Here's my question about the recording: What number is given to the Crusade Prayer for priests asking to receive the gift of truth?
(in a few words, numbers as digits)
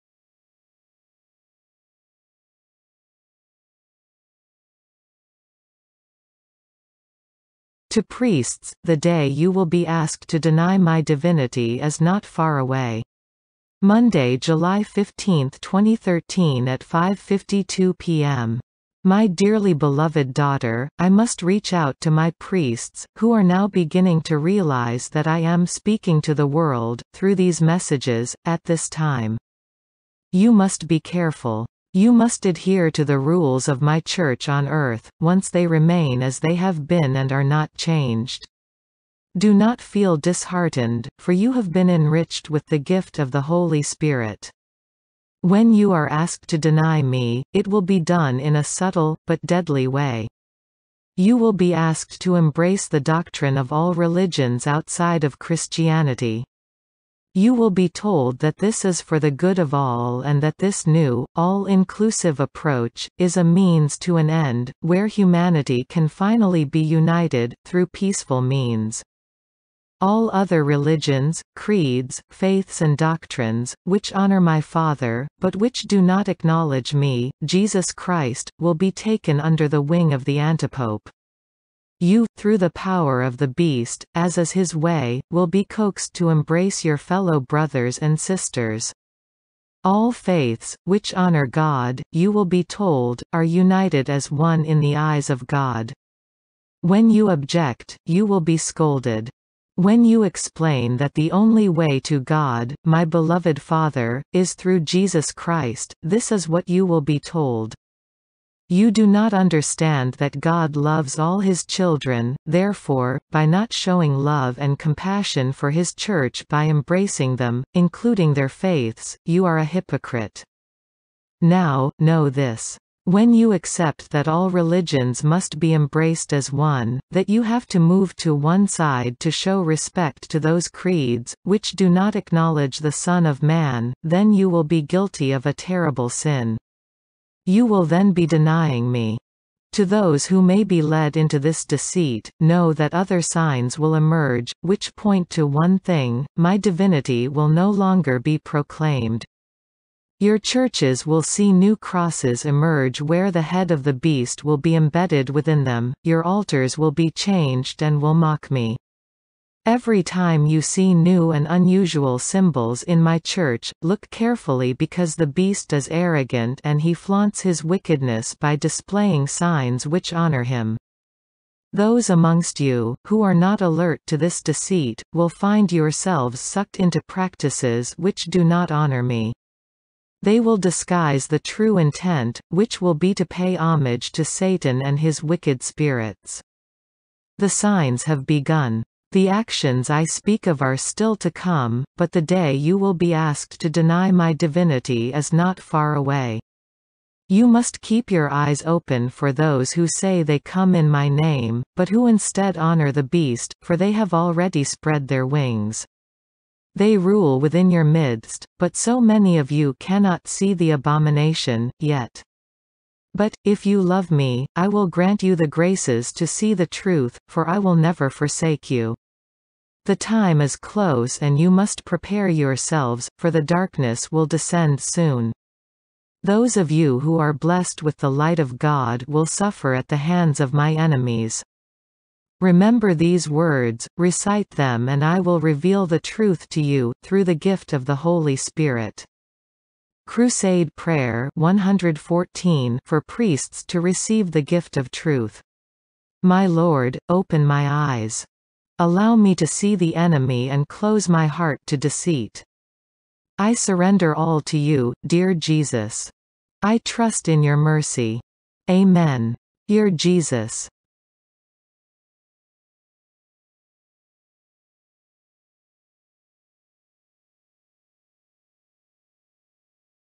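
114.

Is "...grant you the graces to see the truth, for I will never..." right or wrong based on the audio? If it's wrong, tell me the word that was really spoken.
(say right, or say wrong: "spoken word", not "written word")
right.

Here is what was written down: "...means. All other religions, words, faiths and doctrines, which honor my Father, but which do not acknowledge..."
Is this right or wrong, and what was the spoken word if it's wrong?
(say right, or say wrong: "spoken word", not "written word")
wrong: "creeds", not "words".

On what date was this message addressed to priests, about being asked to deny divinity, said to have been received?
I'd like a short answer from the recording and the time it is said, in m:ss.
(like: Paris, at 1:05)
Monday, July 15, 2013, at 0:13.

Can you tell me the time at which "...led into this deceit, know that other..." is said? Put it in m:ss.
2:20.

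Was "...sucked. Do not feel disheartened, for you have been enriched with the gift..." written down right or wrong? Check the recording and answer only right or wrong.
wrong.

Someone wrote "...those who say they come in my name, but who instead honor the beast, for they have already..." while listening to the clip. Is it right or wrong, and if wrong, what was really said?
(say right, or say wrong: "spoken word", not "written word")
right.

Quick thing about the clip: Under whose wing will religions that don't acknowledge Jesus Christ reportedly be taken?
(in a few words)
The antipope.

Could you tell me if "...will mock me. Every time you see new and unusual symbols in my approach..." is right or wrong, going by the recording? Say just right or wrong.
wrong.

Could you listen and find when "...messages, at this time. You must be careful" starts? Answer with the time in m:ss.
0:27.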